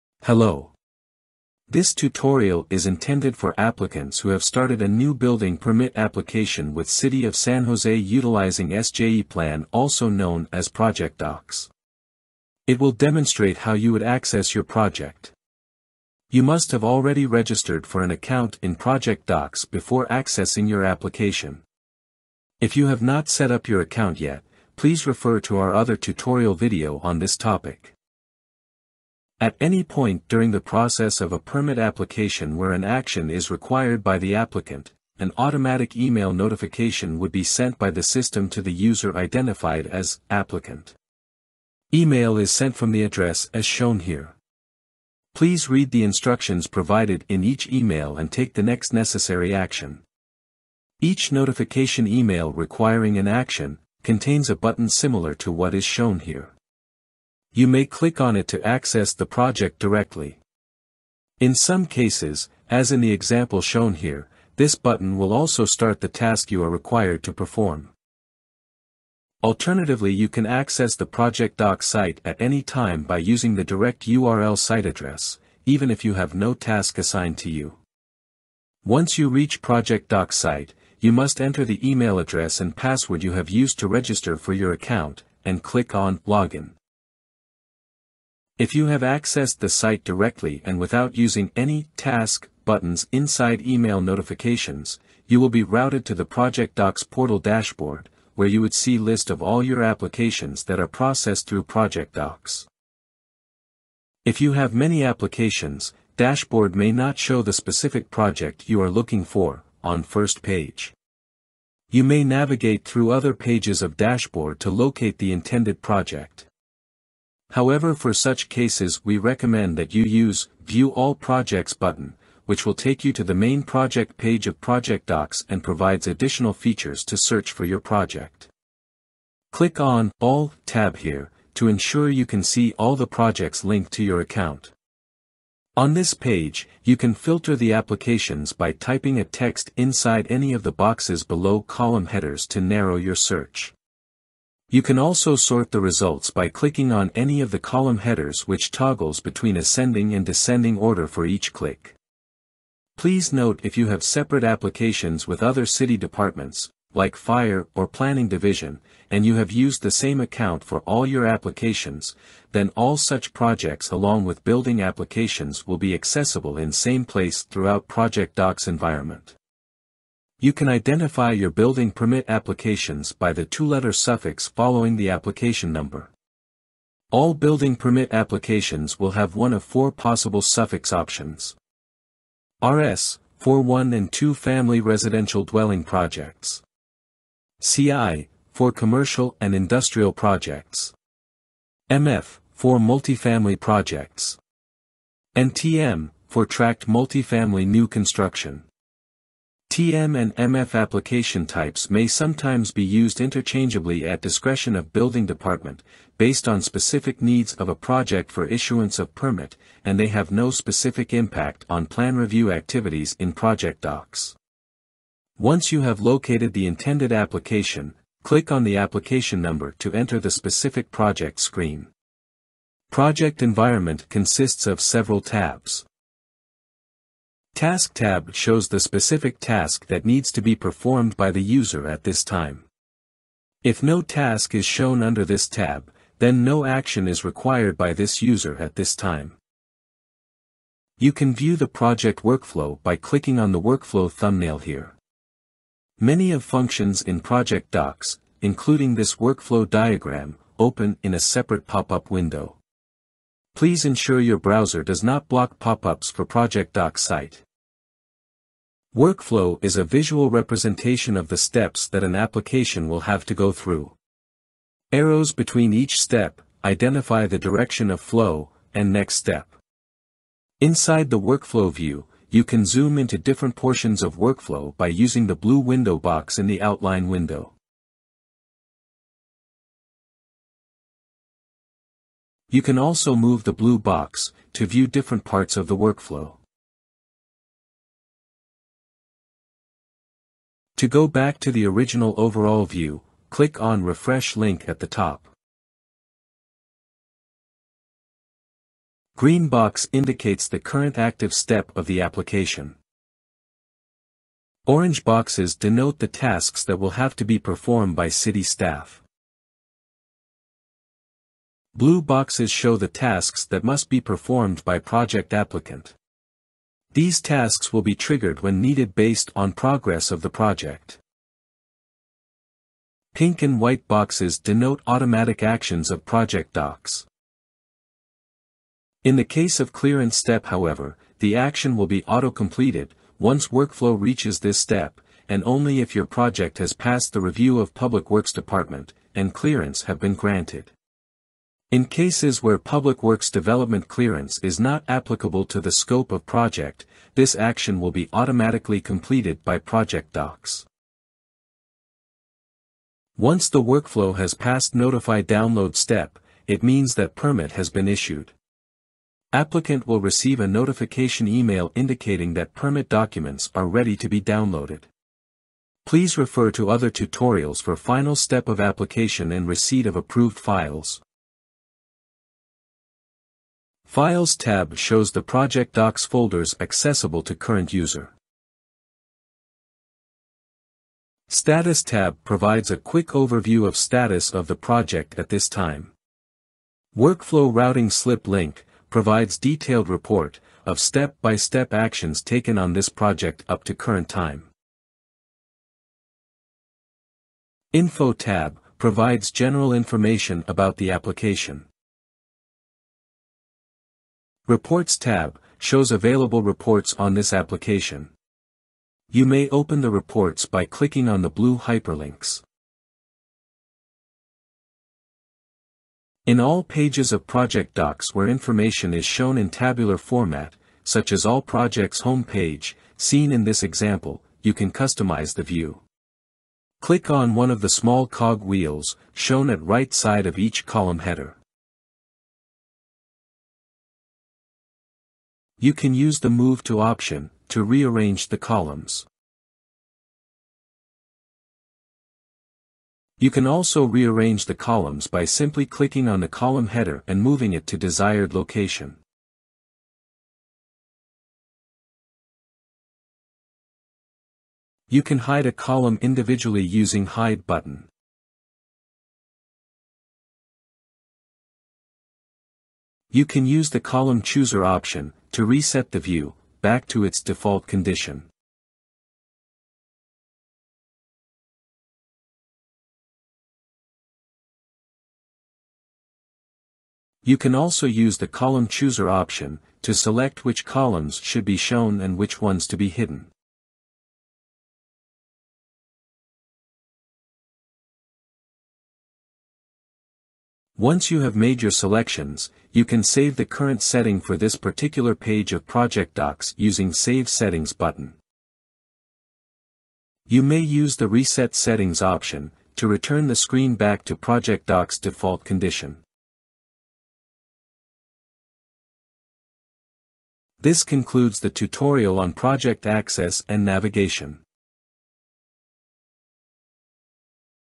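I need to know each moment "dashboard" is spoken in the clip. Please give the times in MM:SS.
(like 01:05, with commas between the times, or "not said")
01:37, 01:46, 01:53.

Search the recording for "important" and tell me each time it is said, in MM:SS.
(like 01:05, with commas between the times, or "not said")
not said.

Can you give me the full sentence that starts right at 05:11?
Blue boxes show the tasks that must be performed by project applicant.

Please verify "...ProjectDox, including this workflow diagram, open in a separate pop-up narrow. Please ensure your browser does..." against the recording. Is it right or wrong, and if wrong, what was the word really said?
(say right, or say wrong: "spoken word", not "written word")
wrong: "window", not "narrow".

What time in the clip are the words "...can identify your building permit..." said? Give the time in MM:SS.
02:50.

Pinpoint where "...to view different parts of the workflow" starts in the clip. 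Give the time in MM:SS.
04:44.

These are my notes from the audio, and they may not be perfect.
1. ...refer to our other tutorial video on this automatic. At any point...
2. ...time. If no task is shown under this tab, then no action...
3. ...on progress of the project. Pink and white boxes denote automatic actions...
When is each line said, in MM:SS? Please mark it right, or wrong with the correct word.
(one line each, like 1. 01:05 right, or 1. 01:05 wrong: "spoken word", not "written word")
1. 00:25 wrong: "topic", not "automatic"
2. 03:52 right
3. 05:19 right.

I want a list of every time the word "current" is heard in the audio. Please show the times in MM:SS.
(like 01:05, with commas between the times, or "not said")
05:00, 06:17, 06:33, 08:13.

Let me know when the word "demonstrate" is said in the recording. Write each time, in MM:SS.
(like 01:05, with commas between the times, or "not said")
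00:12.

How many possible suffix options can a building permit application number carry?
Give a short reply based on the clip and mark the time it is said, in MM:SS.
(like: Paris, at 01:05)
4, at 02:59.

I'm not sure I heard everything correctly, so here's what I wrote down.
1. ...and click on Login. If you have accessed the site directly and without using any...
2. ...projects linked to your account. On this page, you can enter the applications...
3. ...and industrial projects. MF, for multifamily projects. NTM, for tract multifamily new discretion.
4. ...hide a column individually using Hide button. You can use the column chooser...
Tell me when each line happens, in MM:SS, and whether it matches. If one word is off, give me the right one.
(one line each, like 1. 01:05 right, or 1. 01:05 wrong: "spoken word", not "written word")
1. 01:25 right
2. 02:13 wrong: "filter", not "enter"
3. 03:09 wrong: "construction", not "discretion"
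4. 07:35 right.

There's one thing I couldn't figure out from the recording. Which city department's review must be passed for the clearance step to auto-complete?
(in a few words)
Public Works Department.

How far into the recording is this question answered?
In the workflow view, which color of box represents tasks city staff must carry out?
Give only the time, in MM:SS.
05:04.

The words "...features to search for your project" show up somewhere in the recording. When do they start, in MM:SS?
02:06.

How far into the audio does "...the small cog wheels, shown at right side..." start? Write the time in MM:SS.
07:07.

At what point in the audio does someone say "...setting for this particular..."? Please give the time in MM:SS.
08:13.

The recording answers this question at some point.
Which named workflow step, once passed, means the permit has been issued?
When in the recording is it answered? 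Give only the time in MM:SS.
05:54.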